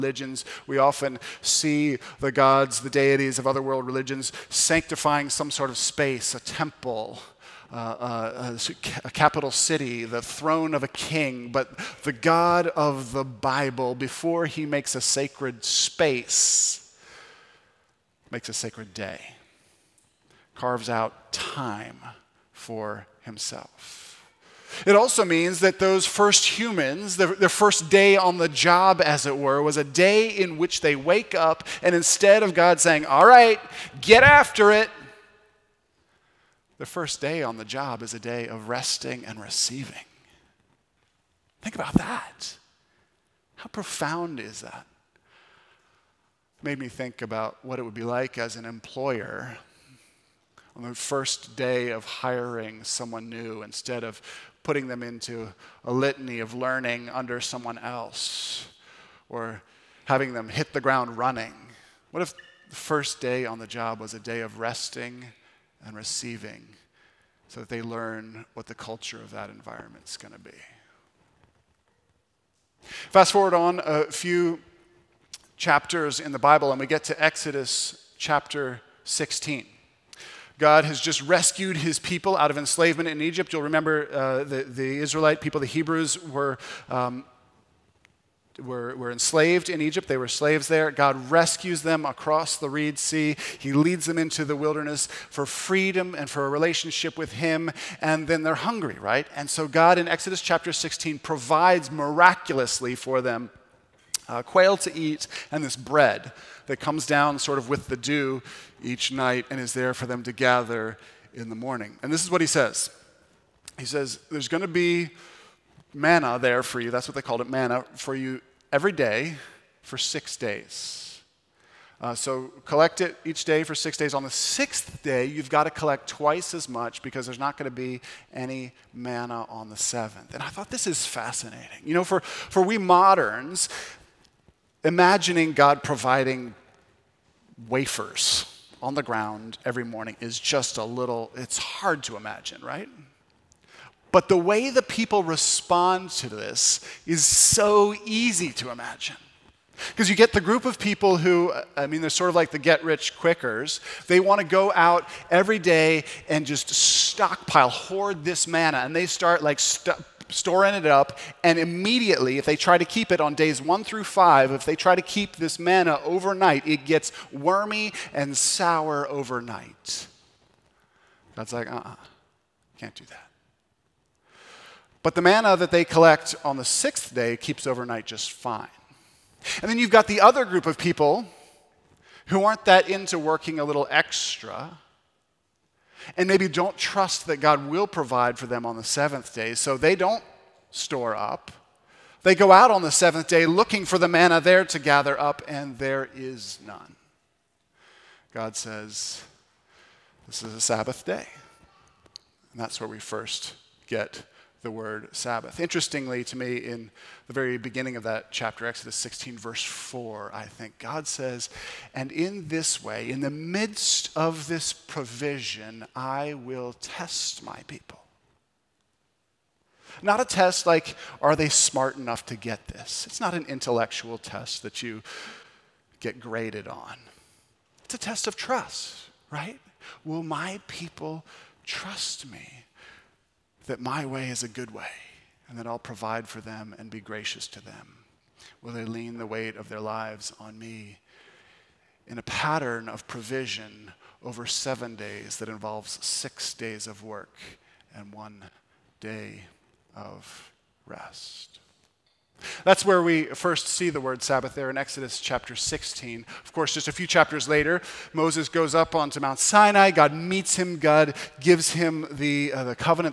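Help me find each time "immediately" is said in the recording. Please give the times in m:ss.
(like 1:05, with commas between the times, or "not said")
2:41.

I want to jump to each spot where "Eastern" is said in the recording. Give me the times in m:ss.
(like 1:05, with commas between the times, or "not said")
not said.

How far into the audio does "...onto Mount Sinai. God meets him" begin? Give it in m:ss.
4:18.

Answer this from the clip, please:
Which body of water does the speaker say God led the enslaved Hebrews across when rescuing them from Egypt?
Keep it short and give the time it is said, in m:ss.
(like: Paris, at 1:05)
Reed Sea, at 1:32.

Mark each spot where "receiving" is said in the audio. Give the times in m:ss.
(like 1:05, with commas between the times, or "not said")
0:39, 1:05.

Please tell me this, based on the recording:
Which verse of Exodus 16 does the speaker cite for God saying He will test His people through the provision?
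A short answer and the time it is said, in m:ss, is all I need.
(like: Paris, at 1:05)
verse 4, at 3:29.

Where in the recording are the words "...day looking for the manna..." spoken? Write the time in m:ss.
3:13.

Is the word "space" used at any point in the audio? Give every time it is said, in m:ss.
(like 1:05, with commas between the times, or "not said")
0:05, 0:15.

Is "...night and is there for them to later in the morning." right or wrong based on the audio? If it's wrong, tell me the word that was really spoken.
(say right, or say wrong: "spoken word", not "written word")
wrong: "gather", not "later".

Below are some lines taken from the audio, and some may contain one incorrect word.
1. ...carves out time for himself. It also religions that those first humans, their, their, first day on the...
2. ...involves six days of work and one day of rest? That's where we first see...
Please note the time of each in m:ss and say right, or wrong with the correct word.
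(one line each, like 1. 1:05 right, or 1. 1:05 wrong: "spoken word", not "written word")
1. 0:20 wrong: "means", not "religions"
2. 4:05 right.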